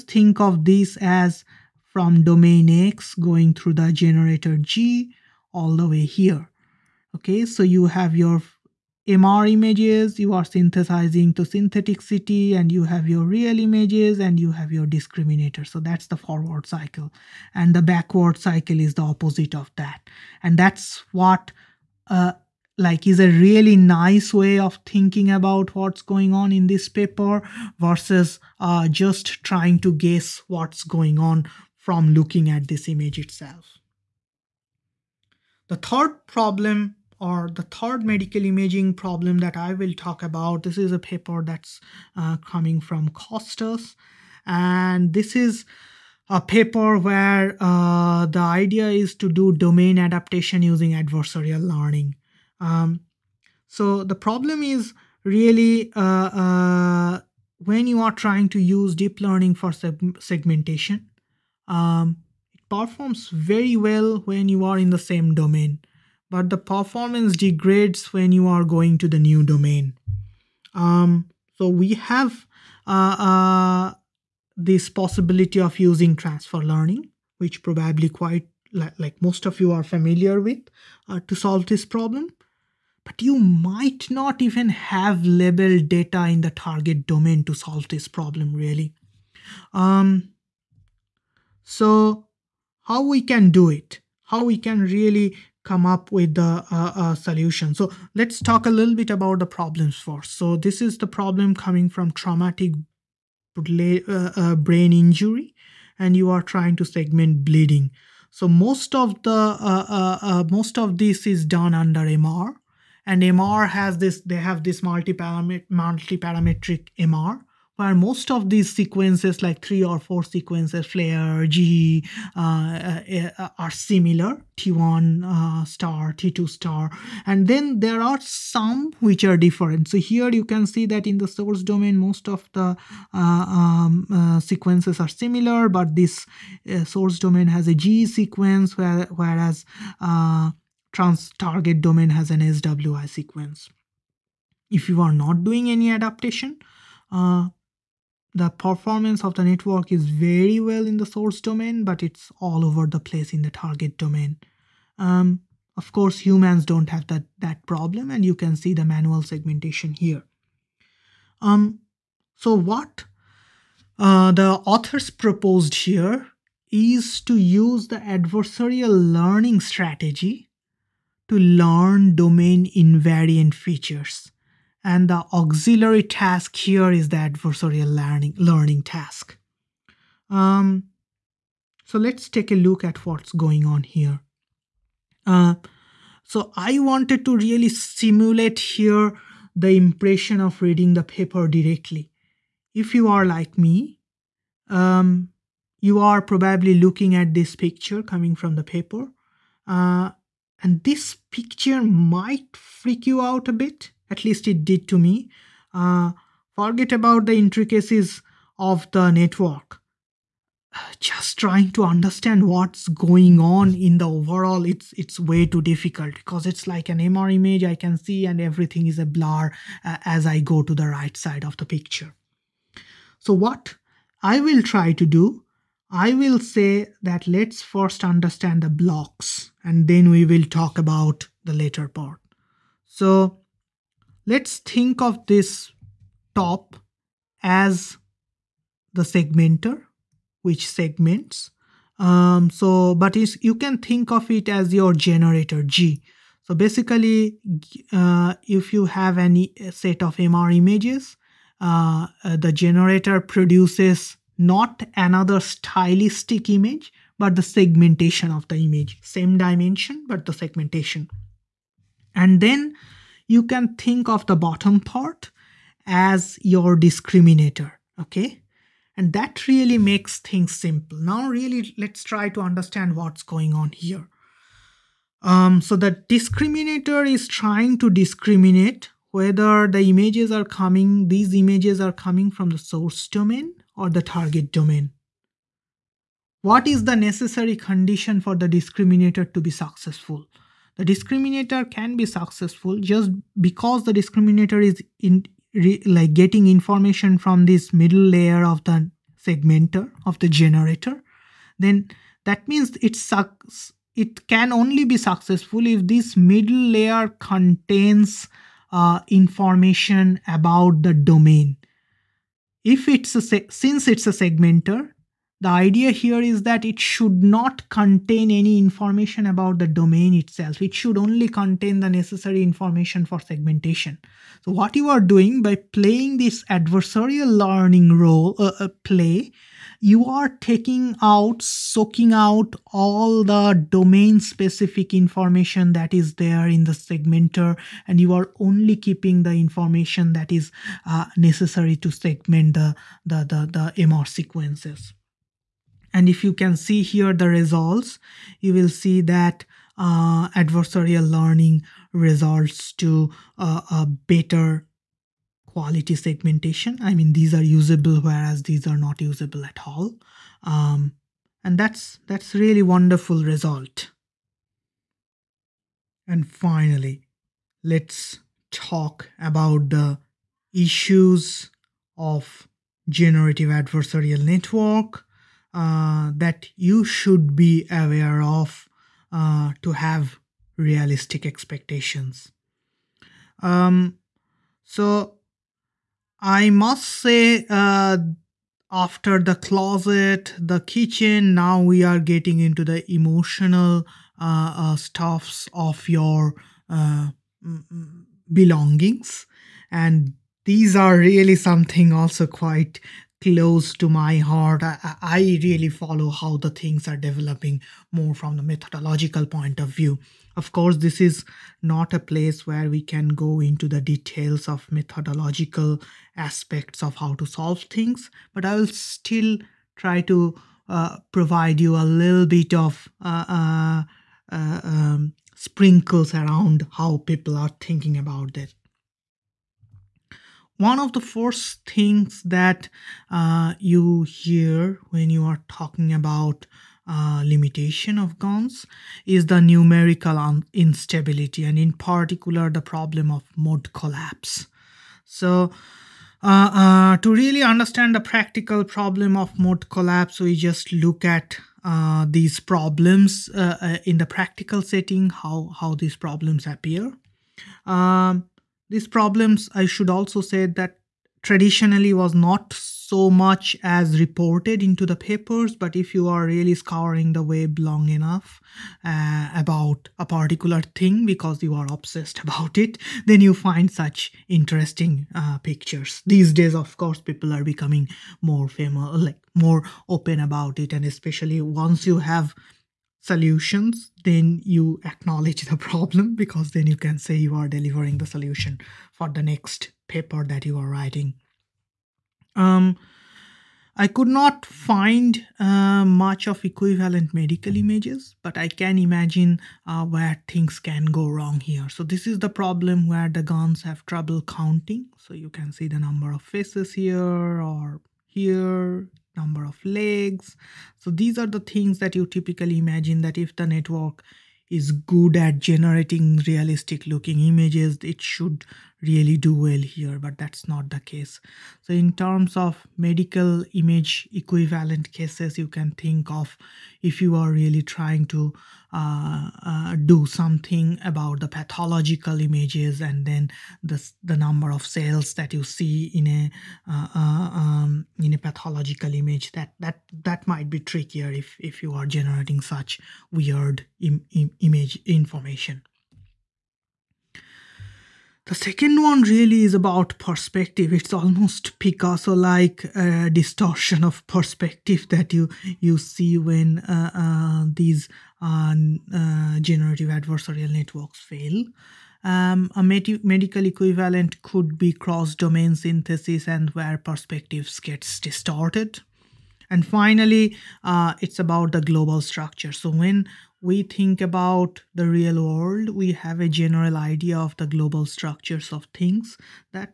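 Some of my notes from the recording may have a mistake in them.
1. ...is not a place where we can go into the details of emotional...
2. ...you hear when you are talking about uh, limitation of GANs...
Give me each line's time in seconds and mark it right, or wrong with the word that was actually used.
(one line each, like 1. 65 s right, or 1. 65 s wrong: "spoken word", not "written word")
1. 411 s wrong: "methodological", not "emotional"
2. 433 s right.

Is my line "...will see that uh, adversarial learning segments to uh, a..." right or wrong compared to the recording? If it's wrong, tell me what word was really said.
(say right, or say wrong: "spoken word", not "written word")
wrong: "results", not "segments".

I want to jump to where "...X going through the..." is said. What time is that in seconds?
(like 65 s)
2 s.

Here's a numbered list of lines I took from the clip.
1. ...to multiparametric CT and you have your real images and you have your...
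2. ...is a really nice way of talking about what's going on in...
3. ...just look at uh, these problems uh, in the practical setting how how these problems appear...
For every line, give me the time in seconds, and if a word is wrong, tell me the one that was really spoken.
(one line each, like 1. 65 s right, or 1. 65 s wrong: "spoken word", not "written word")
1. 11 s wrong: "synthetic", not "multiparametric"
2. 23 s wrong: "thinking", not "talking"
3. 450 s right.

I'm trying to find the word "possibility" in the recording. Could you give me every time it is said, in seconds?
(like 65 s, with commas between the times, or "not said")
74 s.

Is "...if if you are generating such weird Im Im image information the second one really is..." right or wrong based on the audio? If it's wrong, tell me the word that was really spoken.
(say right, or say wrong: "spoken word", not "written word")
right.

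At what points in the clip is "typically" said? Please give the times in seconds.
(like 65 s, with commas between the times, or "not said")
512 s.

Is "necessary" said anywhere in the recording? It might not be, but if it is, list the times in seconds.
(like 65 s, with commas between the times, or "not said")
286 s, 321 s, 341 s.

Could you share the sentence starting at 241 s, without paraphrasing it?
Um, so, but you can think of it as your generator G.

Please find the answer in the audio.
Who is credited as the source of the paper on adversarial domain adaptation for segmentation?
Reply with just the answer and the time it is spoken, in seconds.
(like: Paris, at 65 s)
Costas, at 43 s.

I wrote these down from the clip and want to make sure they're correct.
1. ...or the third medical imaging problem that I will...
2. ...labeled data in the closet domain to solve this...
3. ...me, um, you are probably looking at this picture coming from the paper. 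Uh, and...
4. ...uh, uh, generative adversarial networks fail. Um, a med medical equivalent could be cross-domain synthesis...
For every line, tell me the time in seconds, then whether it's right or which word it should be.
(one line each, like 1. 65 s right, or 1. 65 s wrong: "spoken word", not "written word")
1. 37 s right
2. 85 s wrong: "target", not "closet"
3. 193 s right
4. 558 s right.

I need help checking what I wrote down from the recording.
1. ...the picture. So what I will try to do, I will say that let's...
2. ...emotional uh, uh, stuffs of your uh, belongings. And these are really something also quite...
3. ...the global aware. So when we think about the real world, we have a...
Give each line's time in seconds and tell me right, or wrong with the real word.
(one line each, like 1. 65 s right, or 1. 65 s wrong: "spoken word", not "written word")
1. 221 s right
2. 392 s right
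3. 571 s wrong: "structure", not "aware".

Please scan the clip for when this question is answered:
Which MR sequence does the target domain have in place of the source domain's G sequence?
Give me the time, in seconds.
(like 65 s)
142 s.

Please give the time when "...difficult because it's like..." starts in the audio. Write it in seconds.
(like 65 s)
215 s.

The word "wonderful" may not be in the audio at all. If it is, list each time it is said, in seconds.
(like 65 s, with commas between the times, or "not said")
362 s.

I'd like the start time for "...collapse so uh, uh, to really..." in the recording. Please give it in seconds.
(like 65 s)
443 s.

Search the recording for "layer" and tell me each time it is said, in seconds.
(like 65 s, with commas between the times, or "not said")
298 s, 306 s.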